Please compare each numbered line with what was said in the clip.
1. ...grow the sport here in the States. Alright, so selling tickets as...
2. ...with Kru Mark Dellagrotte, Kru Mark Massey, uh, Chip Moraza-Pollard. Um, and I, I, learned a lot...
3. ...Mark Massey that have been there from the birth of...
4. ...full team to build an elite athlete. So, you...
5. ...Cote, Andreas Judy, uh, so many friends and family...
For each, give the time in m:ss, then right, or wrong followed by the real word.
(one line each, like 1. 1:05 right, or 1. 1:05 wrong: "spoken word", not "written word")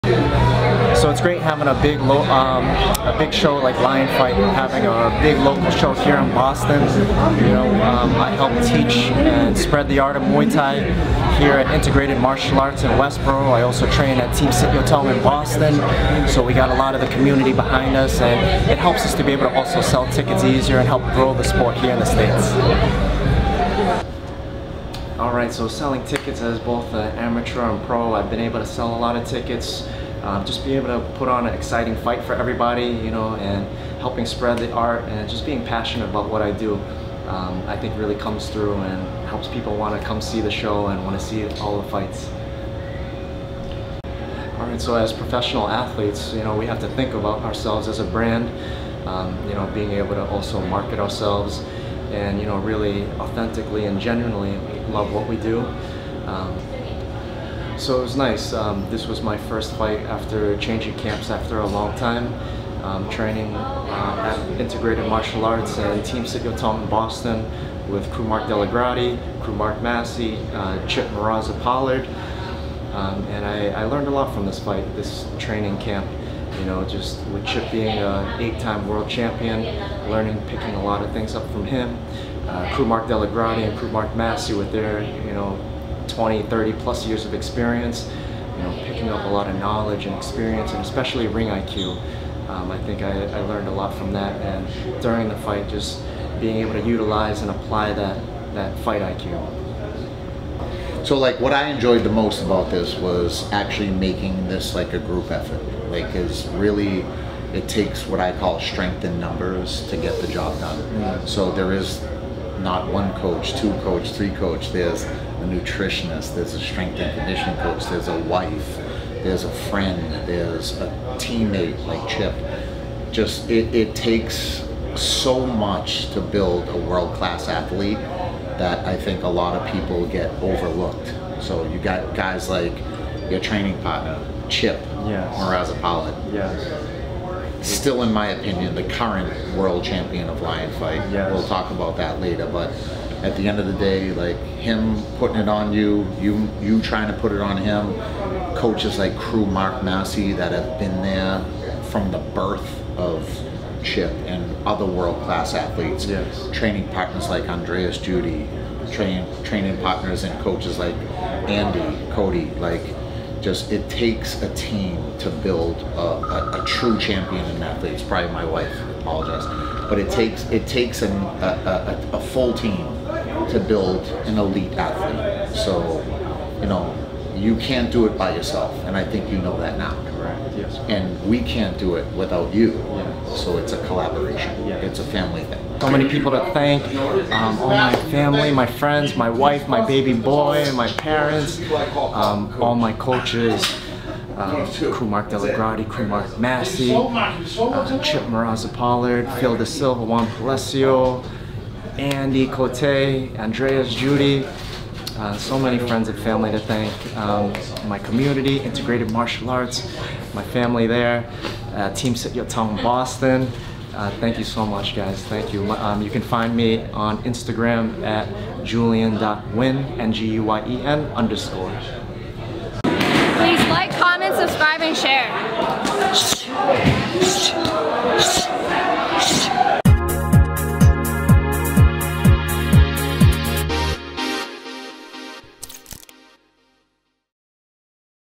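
1. 0:21 right
2. 1:07 right
3. 2:29 right
4. 2:52 right
5. 3:22 right.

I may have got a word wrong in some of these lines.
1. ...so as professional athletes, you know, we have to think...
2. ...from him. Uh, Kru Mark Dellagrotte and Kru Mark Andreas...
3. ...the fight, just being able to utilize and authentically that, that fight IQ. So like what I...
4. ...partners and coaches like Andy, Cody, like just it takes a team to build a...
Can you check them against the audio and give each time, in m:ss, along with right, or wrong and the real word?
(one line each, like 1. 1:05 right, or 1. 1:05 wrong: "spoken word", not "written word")
1. 0:44 right
2. 1:21 wrong: "Massey", not "Andreas"
3. 1:35 wrong: "apply", not "authentically"
4. 2:39 right.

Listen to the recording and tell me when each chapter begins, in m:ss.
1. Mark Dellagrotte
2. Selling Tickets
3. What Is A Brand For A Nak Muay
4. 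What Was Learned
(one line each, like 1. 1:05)
1. 1:42
2. 0:25
3. 0:40
4. 0:58.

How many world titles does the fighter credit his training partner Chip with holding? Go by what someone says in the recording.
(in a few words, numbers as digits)
8.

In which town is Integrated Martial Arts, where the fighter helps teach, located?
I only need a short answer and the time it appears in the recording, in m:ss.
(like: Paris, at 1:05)
Westboro, at 0:12.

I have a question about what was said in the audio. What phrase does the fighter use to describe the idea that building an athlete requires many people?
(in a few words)
Strength in numbers.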